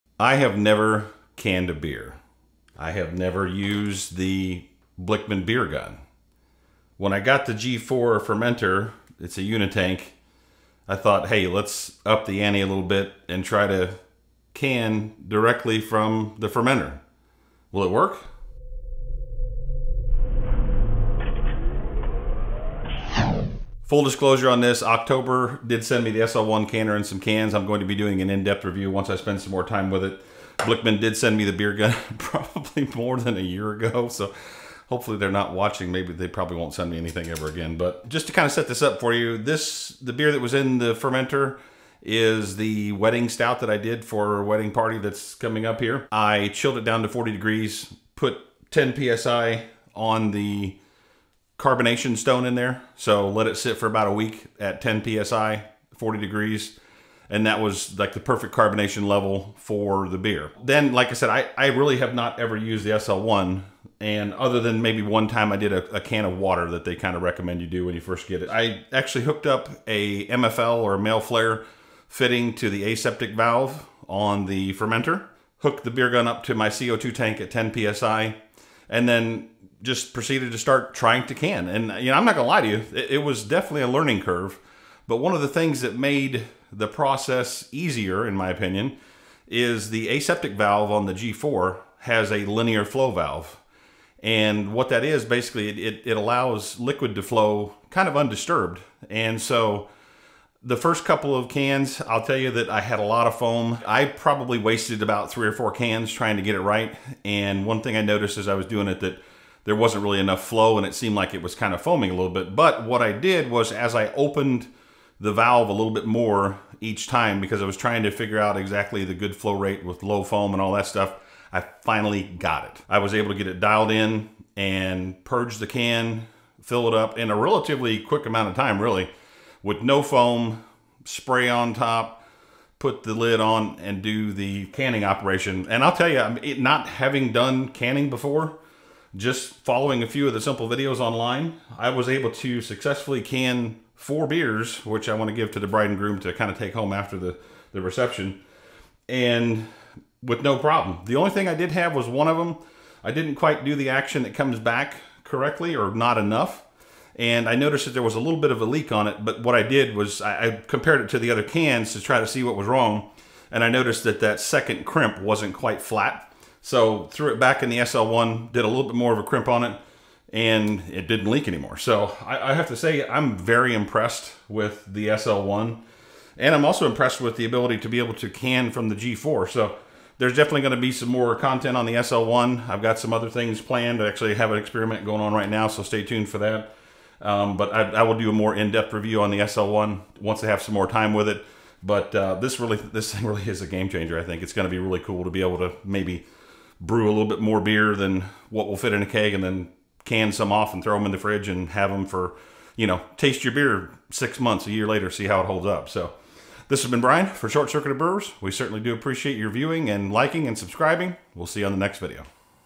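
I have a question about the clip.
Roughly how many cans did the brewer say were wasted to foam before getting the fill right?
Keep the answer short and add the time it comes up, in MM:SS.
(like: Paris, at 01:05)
3 or 4, at 01:45.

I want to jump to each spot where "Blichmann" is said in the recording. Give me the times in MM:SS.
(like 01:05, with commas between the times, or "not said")
00:05, 00:30.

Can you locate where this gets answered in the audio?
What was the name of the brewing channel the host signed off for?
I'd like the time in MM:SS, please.
03:27.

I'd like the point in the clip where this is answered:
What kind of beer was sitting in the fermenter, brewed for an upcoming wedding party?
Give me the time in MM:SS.
00:42.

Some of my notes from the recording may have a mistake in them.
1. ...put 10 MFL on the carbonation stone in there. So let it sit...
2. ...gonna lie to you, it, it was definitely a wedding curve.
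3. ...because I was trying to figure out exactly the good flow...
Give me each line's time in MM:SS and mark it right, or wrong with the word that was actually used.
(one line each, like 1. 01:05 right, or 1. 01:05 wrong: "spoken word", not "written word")
1. 00:48 wrong: "PSI", not "MFL"
2. 01:22 wrong: "learning", not "wedding"
3. 01:57 right.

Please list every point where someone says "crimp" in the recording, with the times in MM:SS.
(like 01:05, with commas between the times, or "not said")
02:44, 02:49.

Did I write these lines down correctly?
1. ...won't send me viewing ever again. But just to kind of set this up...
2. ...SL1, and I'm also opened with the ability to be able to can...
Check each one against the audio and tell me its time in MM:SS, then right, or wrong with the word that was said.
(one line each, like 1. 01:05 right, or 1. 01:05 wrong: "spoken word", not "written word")
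1. 00:36 wrong: "anything", not "viewing"
2. 02:55 wrong: "impressed", not "opened".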